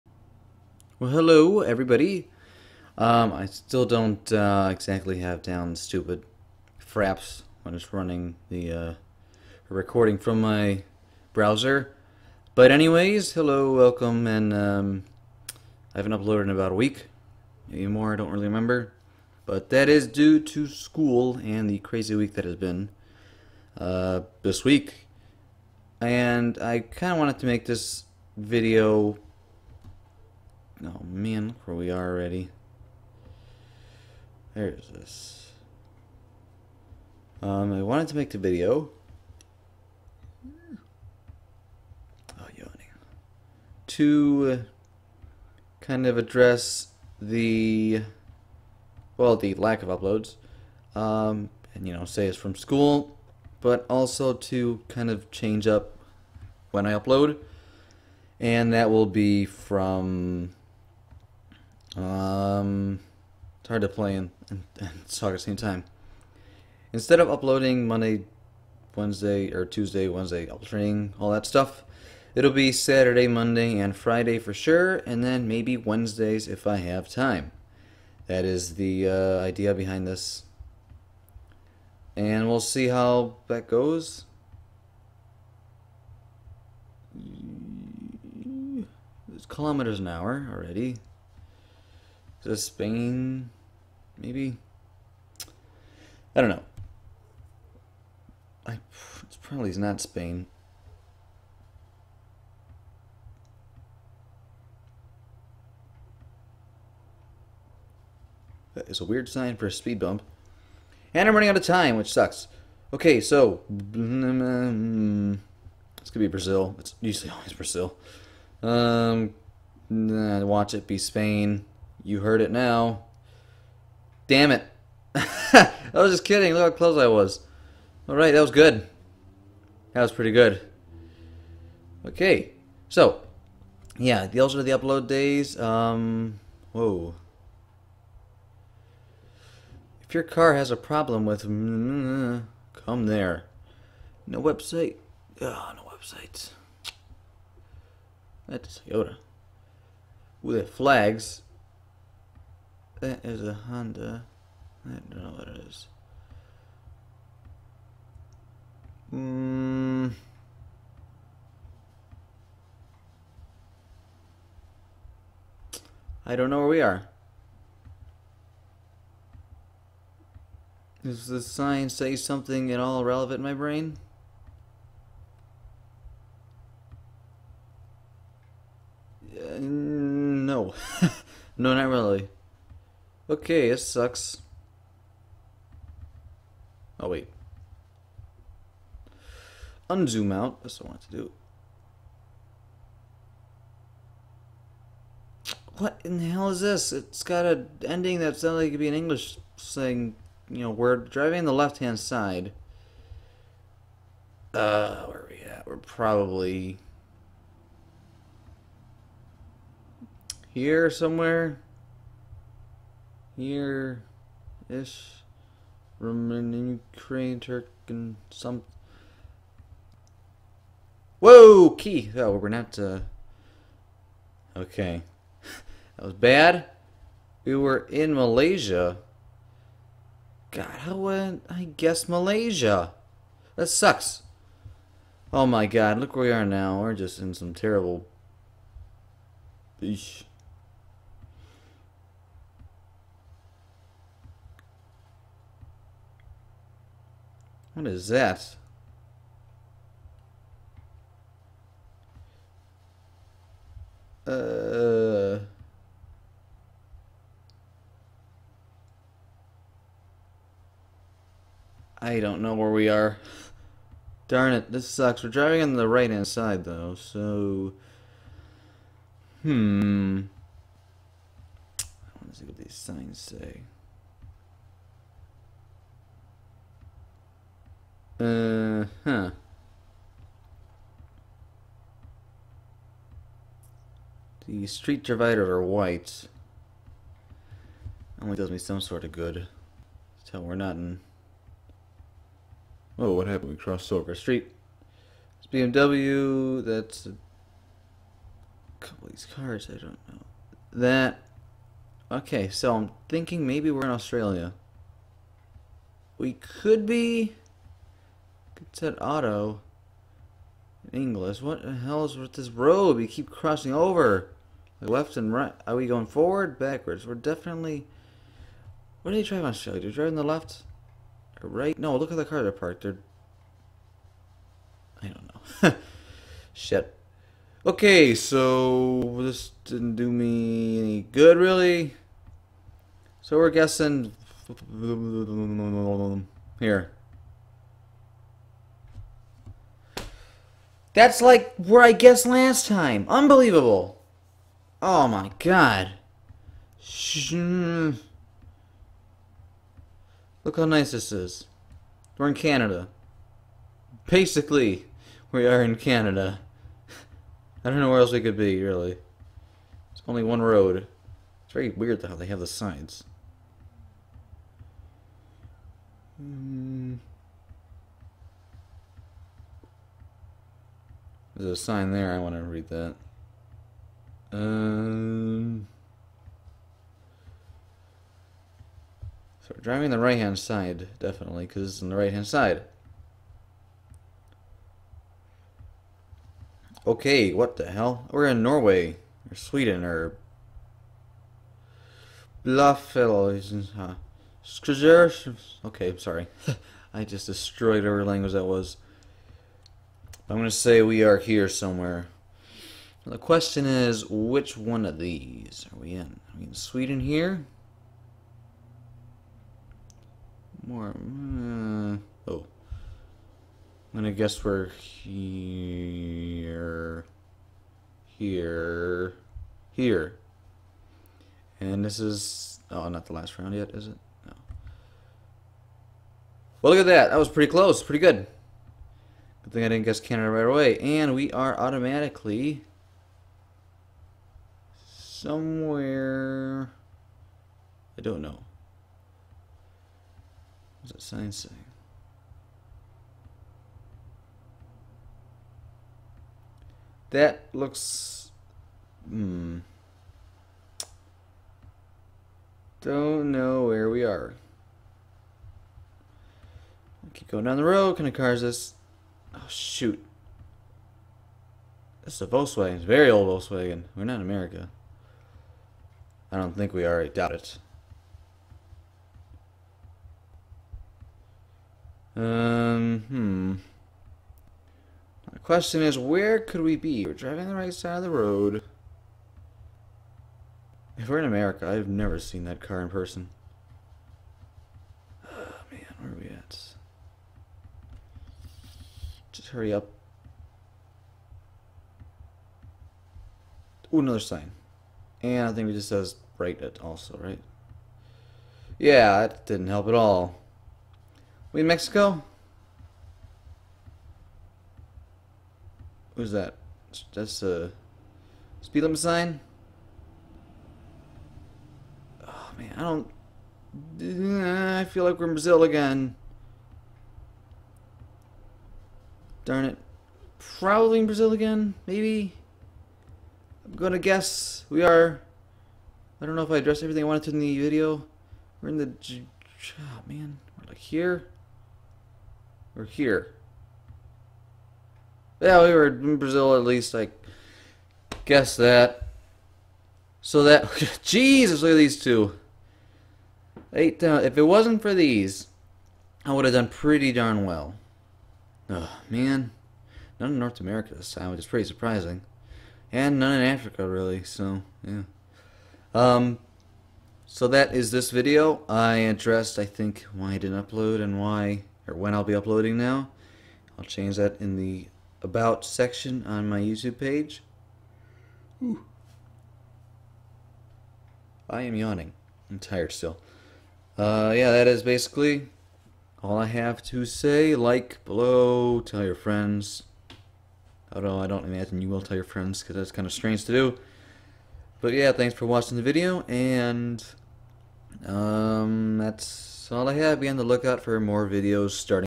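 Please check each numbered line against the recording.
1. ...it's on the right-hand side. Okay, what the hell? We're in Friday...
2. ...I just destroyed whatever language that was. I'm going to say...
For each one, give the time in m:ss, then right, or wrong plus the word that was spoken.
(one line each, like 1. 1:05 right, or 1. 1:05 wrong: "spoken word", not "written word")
1. 6:21 wrong: "Norway", not "Friday"
2. 6:36 right.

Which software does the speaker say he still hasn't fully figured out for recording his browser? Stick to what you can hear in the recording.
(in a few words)
Fraps.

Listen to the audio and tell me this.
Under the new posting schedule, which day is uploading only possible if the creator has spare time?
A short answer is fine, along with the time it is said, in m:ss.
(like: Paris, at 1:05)
Wednesdays, at 1:15.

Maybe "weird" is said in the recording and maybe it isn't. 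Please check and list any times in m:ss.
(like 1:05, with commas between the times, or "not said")
1:49, 6:01.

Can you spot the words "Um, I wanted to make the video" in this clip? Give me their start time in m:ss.
0:37.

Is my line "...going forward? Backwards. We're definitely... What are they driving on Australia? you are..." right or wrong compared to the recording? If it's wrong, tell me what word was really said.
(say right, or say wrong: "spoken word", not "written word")
right.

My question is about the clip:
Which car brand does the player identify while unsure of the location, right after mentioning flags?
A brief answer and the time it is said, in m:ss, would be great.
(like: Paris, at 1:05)
Honda, at 2:33.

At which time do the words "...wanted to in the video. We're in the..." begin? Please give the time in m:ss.
8:47.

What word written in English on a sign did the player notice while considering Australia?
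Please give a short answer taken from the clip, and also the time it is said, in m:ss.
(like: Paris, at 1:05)
auto, at 5:09.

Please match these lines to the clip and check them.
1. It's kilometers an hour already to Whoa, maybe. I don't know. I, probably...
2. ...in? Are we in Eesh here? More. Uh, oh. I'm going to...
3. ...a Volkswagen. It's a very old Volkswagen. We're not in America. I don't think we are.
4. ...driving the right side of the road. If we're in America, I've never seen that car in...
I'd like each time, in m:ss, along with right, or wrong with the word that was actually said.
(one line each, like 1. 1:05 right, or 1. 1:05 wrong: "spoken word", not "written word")
1. 1:29 wrong: "Spain", not "Whoa"
2. 6:45 wrong: "Sweden", not "Eesh"
3. 7:42 right
4. 7:57 right.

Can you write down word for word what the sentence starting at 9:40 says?
Although I don't imagine you will tell your friends because that's kind of strange to do.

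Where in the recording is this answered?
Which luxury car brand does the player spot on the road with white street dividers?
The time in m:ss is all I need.
4:55.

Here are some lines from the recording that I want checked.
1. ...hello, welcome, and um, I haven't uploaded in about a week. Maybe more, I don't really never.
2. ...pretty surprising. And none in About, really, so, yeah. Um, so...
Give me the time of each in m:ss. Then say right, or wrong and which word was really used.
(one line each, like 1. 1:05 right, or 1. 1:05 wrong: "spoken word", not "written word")
1. 0:13 wrong: "remember", not "never"
2. 9:11 wrong: "Africa", not "About".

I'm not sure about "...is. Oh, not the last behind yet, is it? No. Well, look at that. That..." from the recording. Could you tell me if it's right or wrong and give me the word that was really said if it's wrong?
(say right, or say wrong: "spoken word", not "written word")
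wrong: "round", not "behind".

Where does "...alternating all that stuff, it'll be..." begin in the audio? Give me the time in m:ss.
1:10.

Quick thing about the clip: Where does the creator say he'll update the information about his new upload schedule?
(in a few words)
About section.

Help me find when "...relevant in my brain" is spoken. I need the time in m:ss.
2:53.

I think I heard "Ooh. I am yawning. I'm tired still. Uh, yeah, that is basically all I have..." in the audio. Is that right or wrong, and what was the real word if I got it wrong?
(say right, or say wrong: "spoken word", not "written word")
right.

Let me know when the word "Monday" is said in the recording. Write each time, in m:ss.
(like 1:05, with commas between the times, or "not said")
1:07, 1:13.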